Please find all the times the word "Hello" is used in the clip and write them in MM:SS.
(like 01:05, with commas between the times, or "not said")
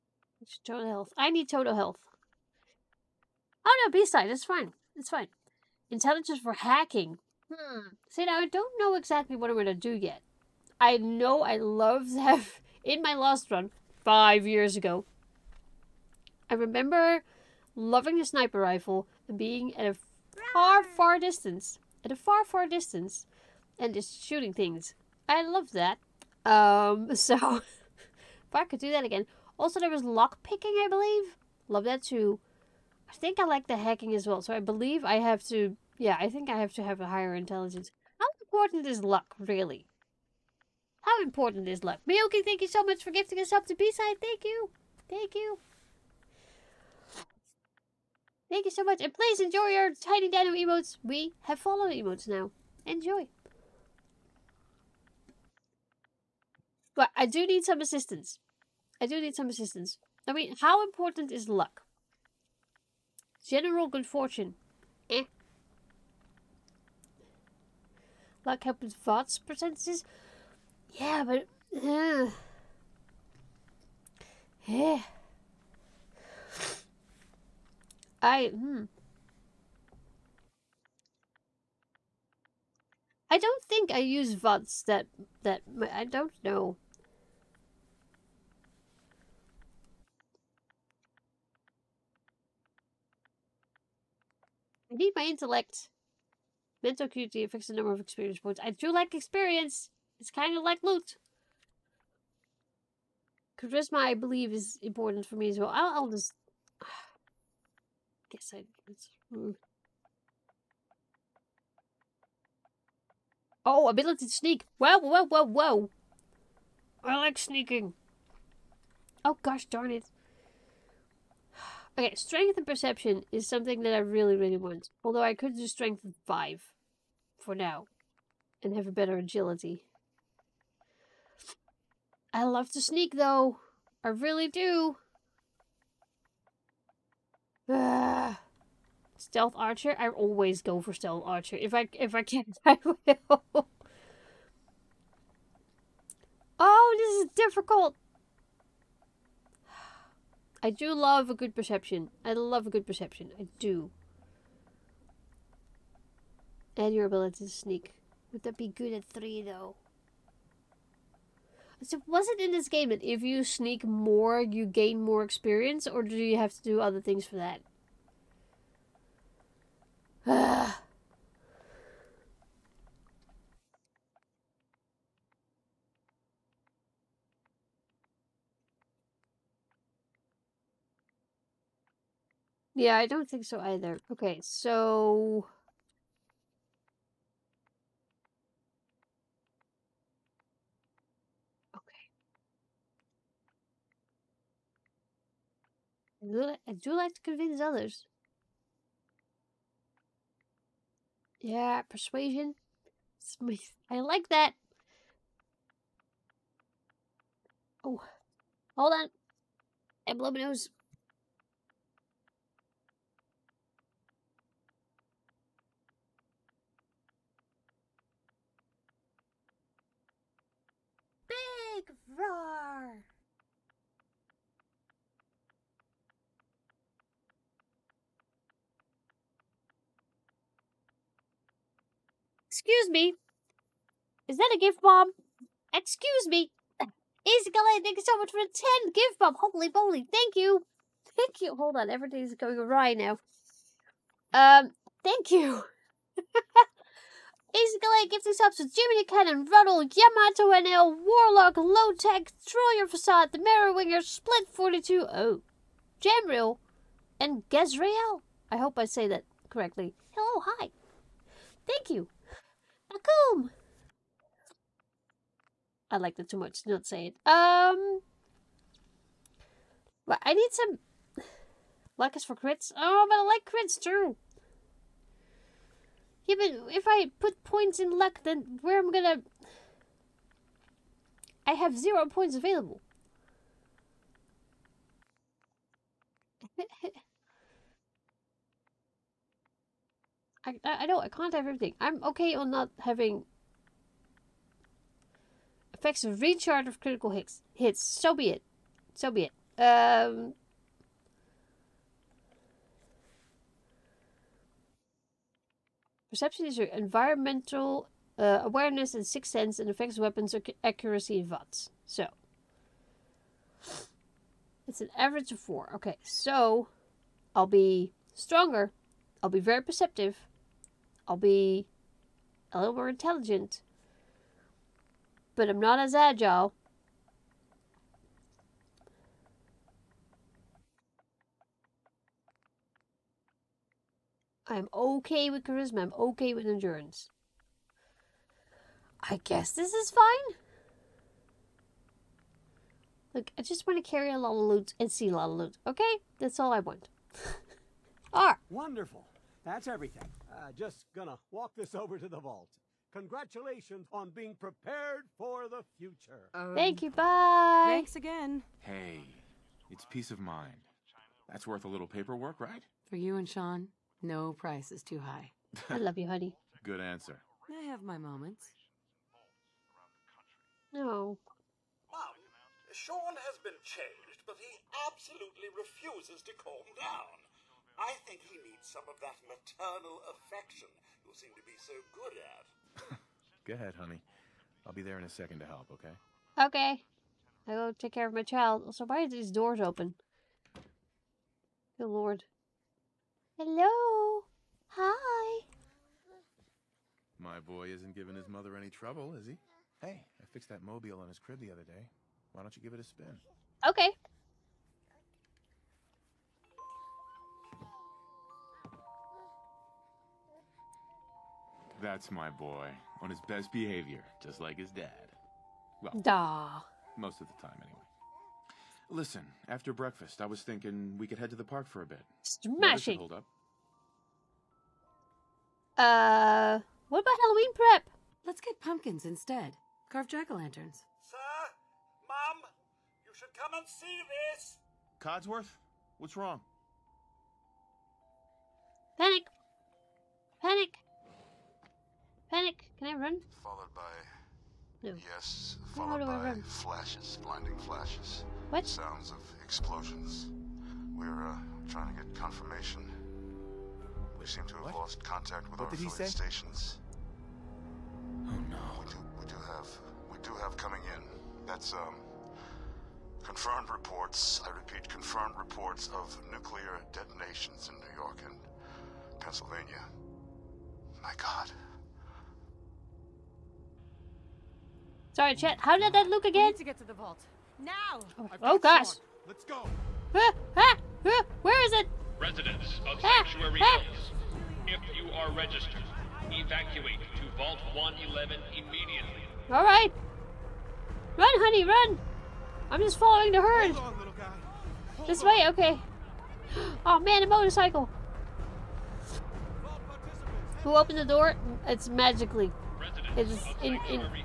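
04:20, 06:33.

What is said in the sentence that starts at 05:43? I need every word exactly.
Look, I just want to carry a lot of loot and see a lot of loot.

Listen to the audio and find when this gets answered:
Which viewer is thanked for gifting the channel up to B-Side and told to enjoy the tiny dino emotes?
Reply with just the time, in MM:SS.
00:42.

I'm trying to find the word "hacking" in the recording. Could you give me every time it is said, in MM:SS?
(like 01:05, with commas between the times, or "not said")
00:06, 00:33.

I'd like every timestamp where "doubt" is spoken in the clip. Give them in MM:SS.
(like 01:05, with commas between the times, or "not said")
not said.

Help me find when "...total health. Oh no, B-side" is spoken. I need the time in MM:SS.
00:01.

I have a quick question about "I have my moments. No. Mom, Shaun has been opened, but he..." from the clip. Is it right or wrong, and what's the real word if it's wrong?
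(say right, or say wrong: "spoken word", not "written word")
wrong: "changed", not "opened".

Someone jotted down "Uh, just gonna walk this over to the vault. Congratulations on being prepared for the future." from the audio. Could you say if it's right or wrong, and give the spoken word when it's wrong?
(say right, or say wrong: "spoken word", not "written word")
right.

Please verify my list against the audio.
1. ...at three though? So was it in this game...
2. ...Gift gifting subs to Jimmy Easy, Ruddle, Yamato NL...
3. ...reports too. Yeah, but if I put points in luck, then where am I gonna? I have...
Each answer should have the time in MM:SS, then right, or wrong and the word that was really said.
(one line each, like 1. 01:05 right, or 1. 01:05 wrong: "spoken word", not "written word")
1. 02:38 right
2. 04:07 wrong: "Cannon", not "Easy"
3. 04:33 wrong: "crits", not "reports".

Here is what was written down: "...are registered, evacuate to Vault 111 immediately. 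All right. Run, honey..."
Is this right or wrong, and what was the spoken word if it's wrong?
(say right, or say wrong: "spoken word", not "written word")
right.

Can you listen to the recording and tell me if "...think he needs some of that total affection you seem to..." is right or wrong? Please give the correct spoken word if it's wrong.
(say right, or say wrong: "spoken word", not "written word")
wrong: "maternal", not "total".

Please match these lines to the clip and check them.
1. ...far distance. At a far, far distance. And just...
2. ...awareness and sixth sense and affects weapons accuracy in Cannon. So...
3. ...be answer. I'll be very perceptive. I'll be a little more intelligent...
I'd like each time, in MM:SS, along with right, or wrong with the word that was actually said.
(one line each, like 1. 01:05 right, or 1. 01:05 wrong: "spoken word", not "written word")
1. 00:20 right
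2. 05:08 wrong: "VATS", not "Cannon"
3. 05:17 wrong: "stronger", not "answer".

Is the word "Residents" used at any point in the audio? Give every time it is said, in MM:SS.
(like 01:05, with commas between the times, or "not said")
08:02, 08:22.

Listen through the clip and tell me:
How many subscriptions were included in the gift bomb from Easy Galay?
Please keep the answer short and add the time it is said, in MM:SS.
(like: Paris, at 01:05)
10, at 03:58.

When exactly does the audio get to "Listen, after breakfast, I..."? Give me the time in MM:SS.
06:58.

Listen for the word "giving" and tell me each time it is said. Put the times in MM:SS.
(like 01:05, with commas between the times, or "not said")
06:37.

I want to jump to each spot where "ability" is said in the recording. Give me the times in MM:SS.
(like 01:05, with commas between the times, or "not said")
01:53, 02:37.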